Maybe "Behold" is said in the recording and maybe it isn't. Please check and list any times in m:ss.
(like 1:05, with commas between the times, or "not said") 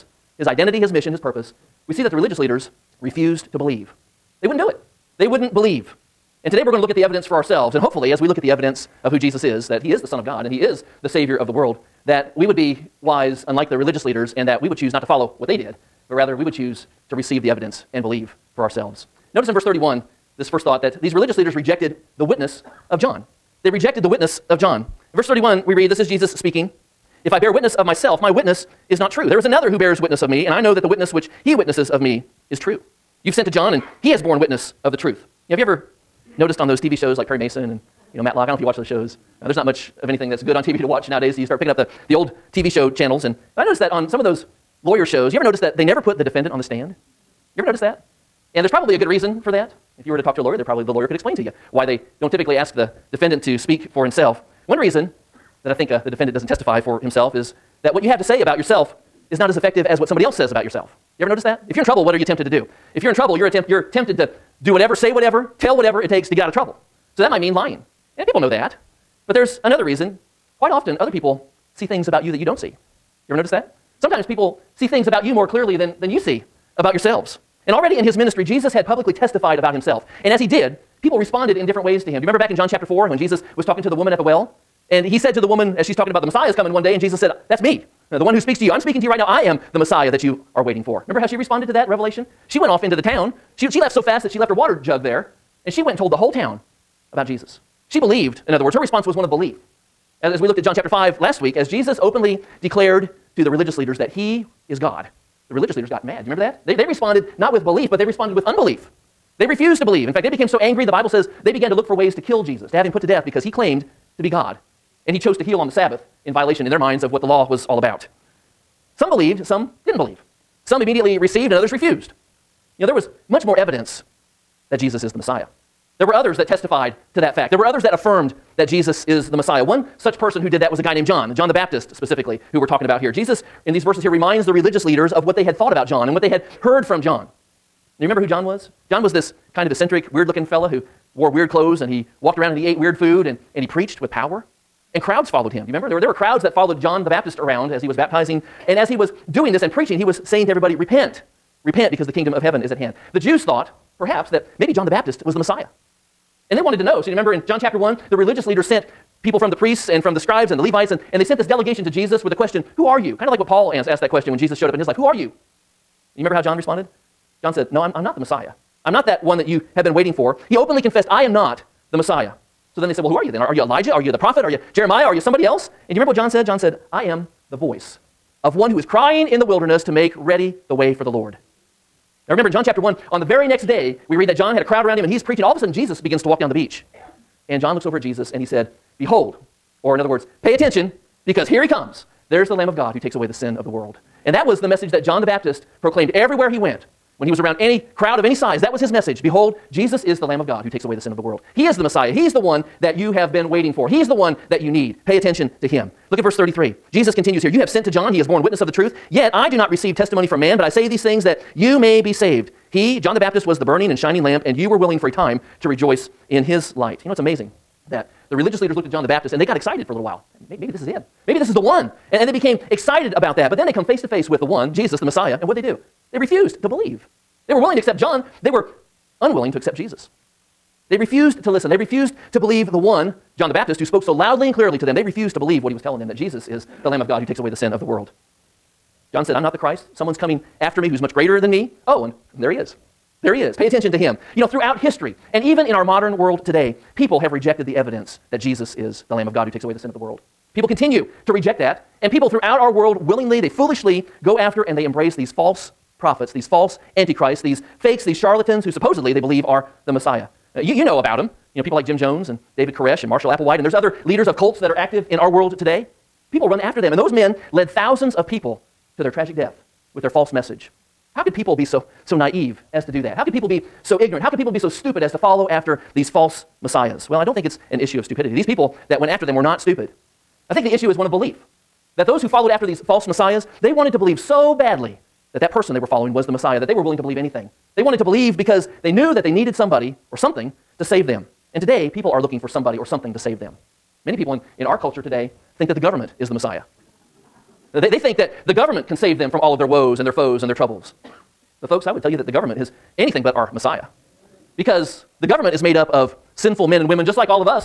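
3:08, 3:19.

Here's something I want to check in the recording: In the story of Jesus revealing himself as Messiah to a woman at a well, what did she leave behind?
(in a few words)
water jug.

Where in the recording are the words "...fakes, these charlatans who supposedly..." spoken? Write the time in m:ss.
4:17.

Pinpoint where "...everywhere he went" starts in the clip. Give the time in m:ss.
3:16.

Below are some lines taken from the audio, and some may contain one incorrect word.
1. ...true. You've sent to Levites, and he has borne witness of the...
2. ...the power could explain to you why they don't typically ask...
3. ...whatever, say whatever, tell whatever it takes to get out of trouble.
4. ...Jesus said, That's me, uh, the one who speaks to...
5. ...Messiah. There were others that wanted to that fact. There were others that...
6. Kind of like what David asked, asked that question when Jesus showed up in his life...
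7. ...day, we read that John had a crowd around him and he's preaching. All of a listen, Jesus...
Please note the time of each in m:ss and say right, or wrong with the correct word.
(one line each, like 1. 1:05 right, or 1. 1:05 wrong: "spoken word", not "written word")
1. 0:32 wrong: "John", not "Levites"
2. 0:50 wrong: "lawyer", not "power"
3. 1:04 right
4. 1:26 right
5. 2:05 wrong: "testified", not "wanted"
6. 2:43 wrong: "Paul", not "David"
7. 3:03 wrong: "sudden", not "listen".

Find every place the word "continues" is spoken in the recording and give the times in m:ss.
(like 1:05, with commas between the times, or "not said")
3:27, 4:10.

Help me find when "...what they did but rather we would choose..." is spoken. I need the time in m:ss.
0:15.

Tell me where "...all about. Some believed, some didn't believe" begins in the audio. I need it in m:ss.
1:57.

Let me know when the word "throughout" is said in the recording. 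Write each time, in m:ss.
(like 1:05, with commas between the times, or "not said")
4:04, 4:12.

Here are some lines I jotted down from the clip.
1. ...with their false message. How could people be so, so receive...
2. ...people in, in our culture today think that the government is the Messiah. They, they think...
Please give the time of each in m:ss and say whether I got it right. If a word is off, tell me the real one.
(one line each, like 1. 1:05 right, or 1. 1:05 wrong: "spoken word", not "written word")
1. 4:29 wrong: "naive", not "receive"
2. 4:54 right.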